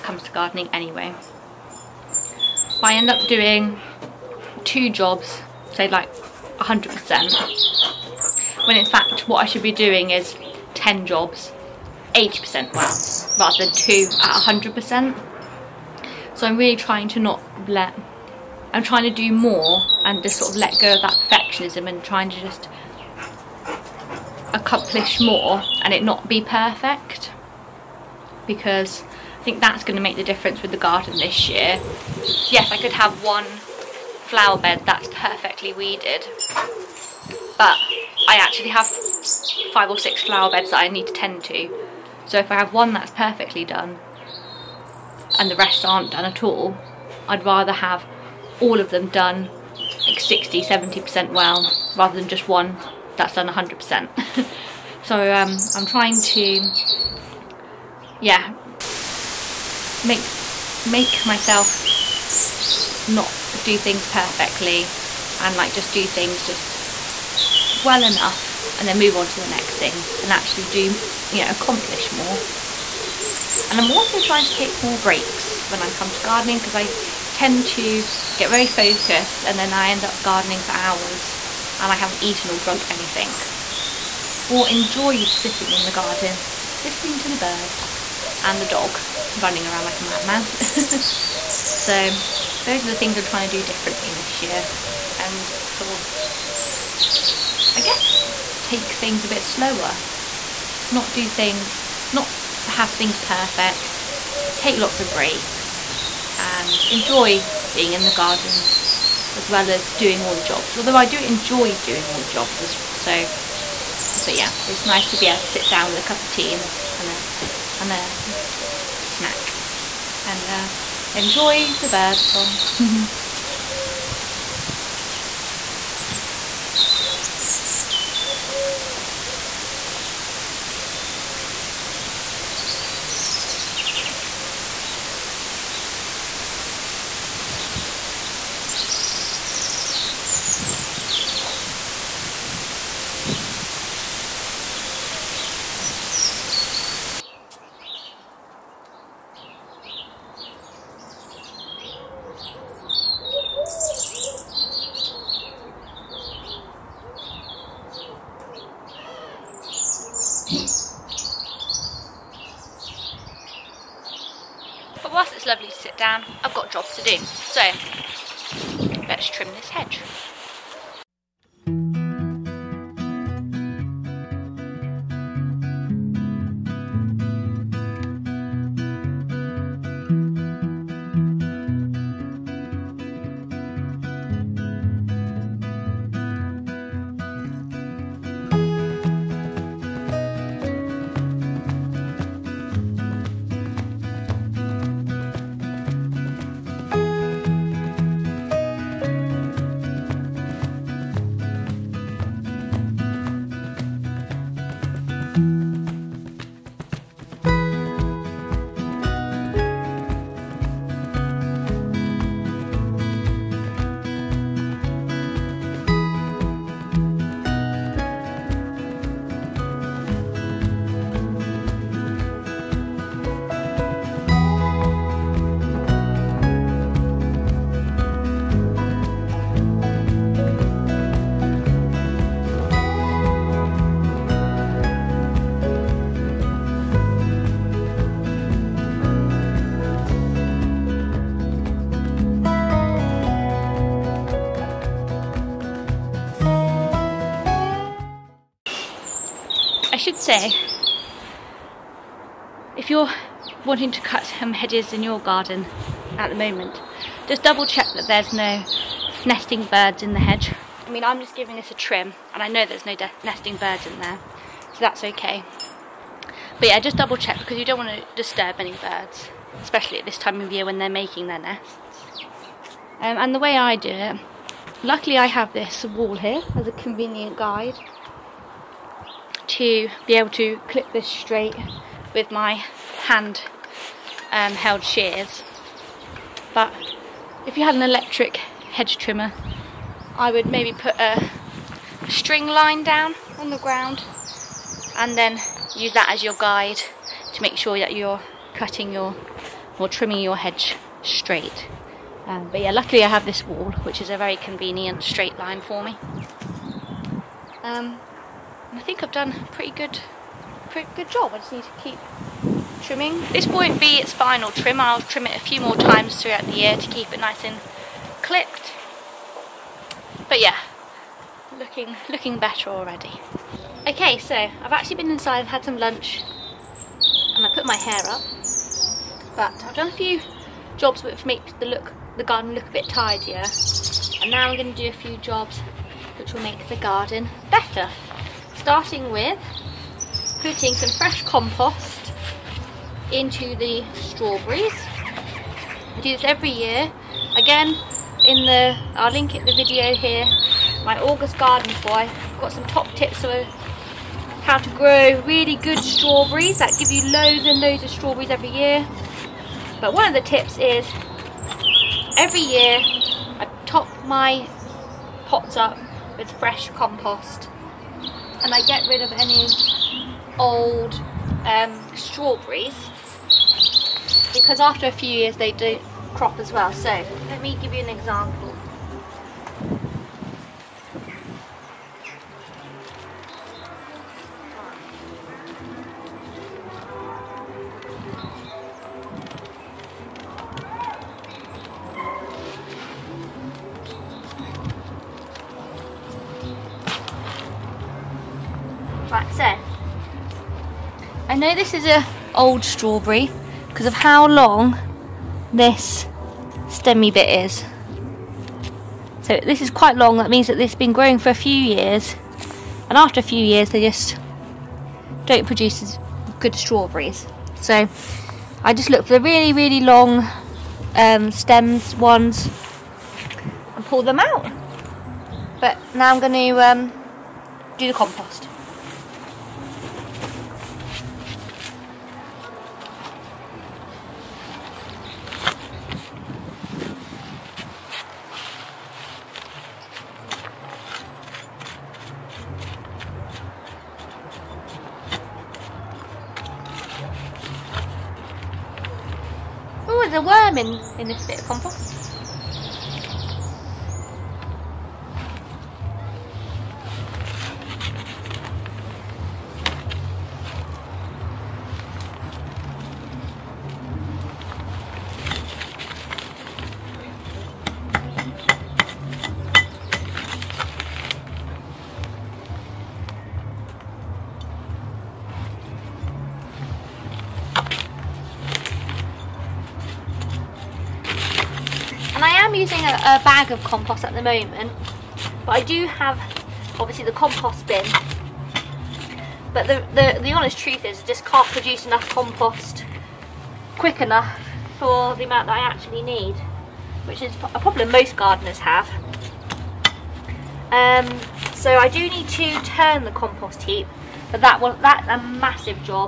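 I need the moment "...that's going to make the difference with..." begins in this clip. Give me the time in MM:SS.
00:29.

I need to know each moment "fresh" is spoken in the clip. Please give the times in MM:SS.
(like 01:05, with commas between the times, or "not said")
05:40, 06:06.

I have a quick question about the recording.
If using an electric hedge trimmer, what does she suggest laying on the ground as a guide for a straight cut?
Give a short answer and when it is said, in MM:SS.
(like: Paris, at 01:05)
string line, at 04:52.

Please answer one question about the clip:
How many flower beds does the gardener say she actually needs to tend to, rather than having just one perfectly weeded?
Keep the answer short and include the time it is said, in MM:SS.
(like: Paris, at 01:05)
5 or 6, at 00:39.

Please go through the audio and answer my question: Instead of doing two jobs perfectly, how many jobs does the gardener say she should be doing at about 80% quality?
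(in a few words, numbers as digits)
10.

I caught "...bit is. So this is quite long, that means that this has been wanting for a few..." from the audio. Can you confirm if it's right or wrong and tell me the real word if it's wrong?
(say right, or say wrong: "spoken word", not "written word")
wrong: "growing", not "wanting".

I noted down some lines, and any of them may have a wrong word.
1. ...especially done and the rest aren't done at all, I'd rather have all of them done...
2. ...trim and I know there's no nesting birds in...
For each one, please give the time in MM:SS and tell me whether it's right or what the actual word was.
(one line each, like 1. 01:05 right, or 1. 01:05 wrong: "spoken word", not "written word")
1. 00:43 wrong: "perfectly", not "especially"
2. 04:21 right.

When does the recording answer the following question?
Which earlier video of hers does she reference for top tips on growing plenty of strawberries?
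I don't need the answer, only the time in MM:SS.
05:51.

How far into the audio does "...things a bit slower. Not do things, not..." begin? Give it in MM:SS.
01:38.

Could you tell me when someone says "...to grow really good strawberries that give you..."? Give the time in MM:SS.
05:54.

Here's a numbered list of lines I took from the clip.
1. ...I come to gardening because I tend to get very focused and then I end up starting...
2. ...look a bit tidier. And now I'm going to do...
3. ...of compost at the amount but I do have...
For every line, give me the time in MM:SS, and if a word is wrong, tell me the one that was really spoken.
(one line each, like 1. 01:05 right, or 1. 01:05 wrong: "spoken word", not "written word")
1. 01:15 wrong: "gardening", not "starting"
2. 05:32 right
3. 08:03 wrong: "moment", not "amount".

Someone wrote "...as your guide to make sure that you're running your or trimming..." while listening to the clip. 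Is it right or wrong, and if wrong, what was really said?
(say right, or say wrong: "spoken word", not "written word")
wrong: "cutting", not "running".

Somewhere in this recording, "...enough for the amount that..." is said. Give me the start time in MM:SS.
08:14.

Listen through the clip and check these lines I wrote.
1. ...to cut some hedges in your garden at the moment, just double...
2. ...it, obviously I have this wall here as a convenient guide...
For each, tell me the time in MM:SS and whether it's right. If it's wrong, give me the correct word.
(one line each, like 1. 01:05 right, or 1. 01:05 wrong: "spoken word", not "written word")
1. 04:13 right
2. 04:33 wrong: "luckily", not "obviously".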